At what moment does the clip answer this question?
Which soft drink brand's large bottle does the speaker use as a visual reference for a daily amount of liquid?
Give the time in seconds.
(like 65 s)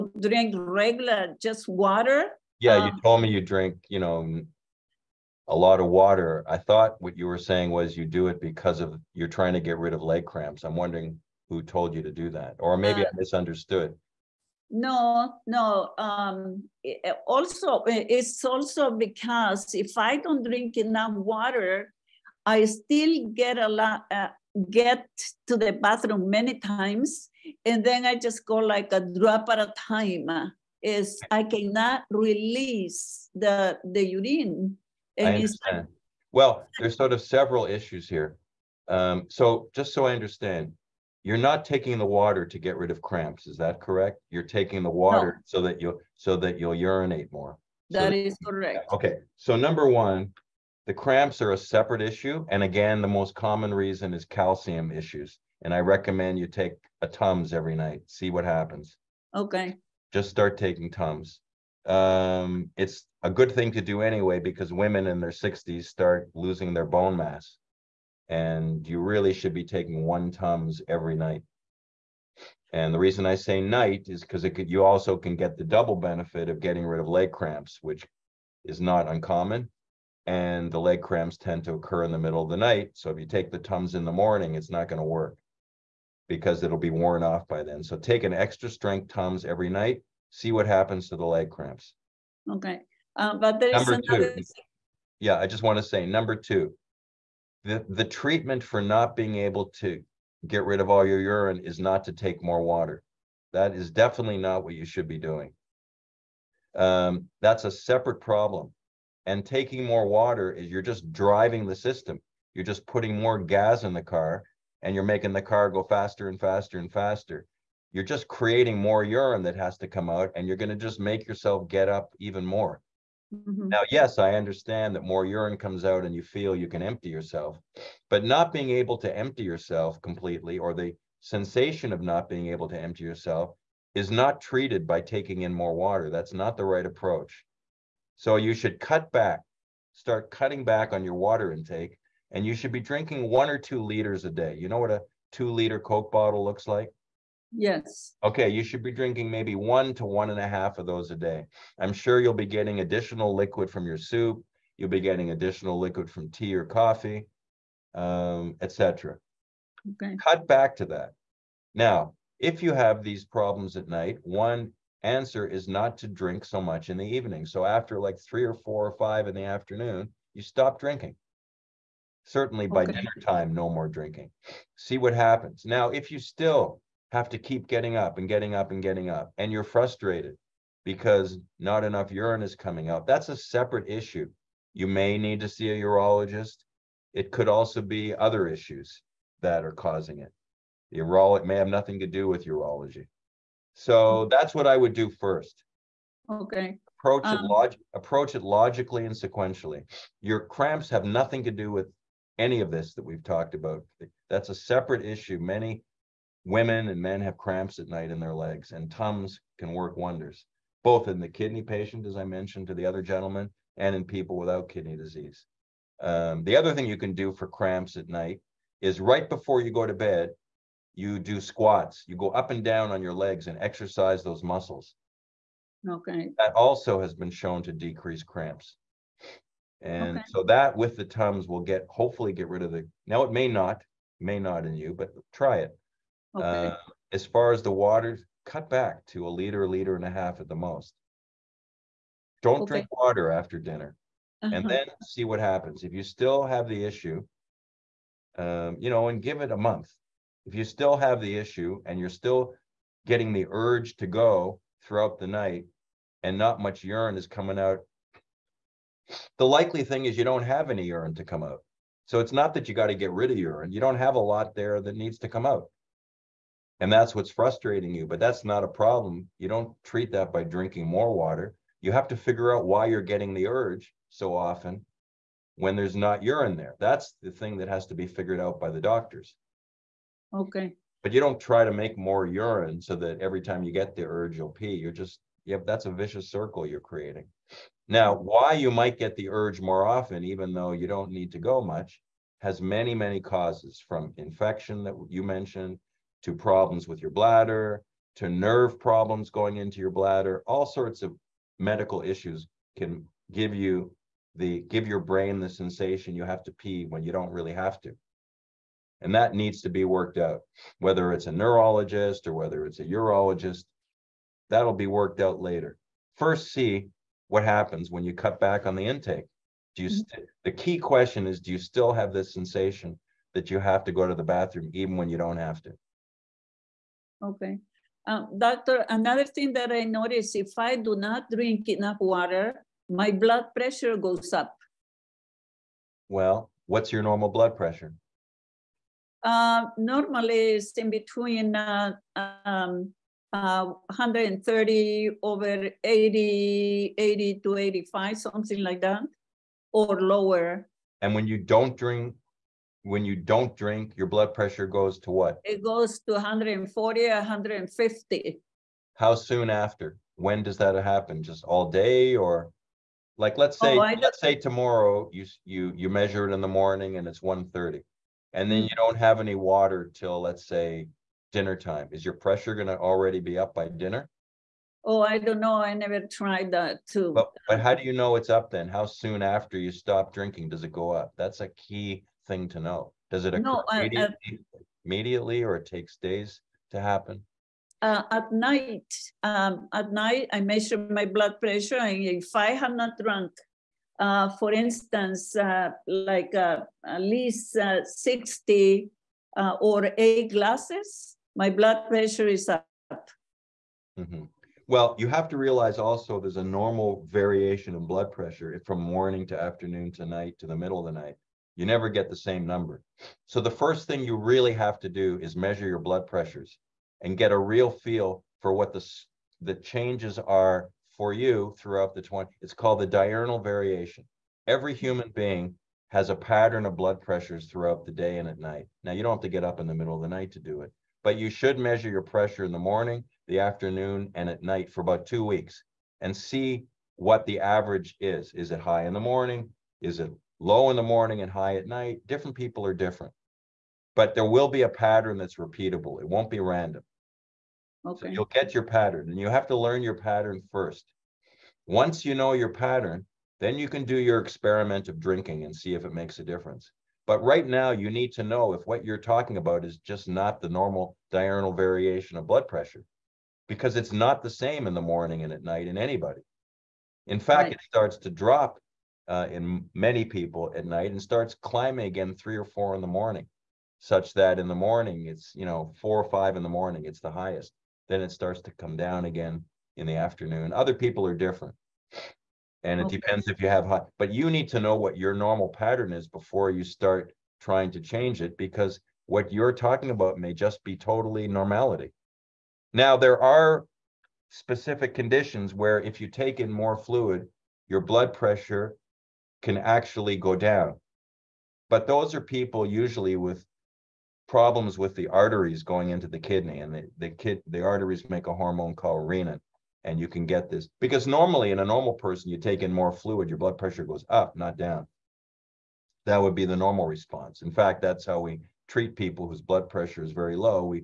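145 s.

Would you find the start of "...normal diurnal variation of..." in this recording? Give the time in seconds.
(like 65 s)
460 s.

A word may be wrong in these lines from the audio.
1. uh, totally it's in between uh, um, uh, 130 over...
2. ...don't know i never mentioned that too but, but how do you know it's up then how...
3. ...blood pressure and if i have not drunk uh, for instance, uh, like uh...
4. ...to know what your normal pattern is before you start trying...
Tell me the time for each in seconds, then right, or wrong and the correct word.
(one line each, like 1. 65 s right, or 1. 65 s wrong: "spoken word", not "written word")
1. 339 s wrong: "normally", not "totally"
2. 375 s wrong: "tried", not "mentioned"
3. 391 s right
4. 484 s right.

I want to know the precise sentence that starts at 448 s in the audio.
So you'll get your pattern and you have to learn your pattern first.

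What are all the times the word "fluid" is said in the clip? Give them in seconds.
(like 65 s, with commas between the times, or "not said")
496 s, 512 s.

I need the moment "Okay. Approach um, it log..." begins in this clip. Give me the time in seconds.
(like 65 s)
196 s.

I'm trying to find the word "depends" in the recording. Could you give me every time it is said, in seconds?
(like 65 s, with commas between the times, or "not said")
482 s.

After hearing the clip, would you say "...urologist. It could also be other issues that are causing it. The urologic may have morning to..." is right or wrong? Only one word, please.
wrong.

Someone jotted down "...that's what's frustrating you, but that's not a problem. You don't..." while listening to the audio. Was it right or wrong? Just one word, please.
right.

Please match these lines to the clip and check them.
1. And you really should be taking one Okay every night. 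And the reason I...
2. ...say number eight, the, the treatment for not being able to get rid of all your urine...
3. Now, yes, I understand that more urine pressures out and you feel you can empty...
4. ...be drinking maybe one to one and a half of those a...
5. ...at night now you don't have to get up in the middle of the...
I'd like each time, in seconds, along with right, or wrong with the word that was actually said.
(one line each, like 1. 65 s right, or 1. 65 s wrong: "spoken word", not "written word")
1. 68 s wrong: "Tums", not "Okay"
2. 95 s wrong: "two", not "eight"
3. 123 s wrong: "comes", not "pressures"
4. 148 s right
5. 428 s right.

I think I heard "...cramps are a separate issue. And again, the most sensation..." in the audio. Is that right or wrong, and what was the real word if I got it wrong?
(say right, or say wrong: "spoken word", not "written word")
wrong: "common", not "sensation".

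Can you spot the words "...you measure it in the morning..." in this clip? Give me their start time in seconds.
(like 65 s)
365 s.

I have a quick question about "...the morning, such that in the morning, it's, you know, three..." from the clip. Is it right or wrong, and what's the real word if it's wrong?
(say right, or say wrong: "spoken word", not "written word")
wrong: "four", not "three".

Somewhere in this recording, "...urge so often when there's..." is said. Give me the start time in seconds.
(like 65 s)
273 s.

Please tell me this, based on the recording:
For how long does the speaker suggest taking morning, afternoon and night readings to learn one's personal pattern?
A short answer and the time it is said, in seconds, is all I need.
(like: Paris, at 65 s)
2 weeks, at 435 s.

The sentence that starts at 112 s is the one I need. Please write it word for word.
You're just putting more gas in the car and you're making the car go faster and faster and faster.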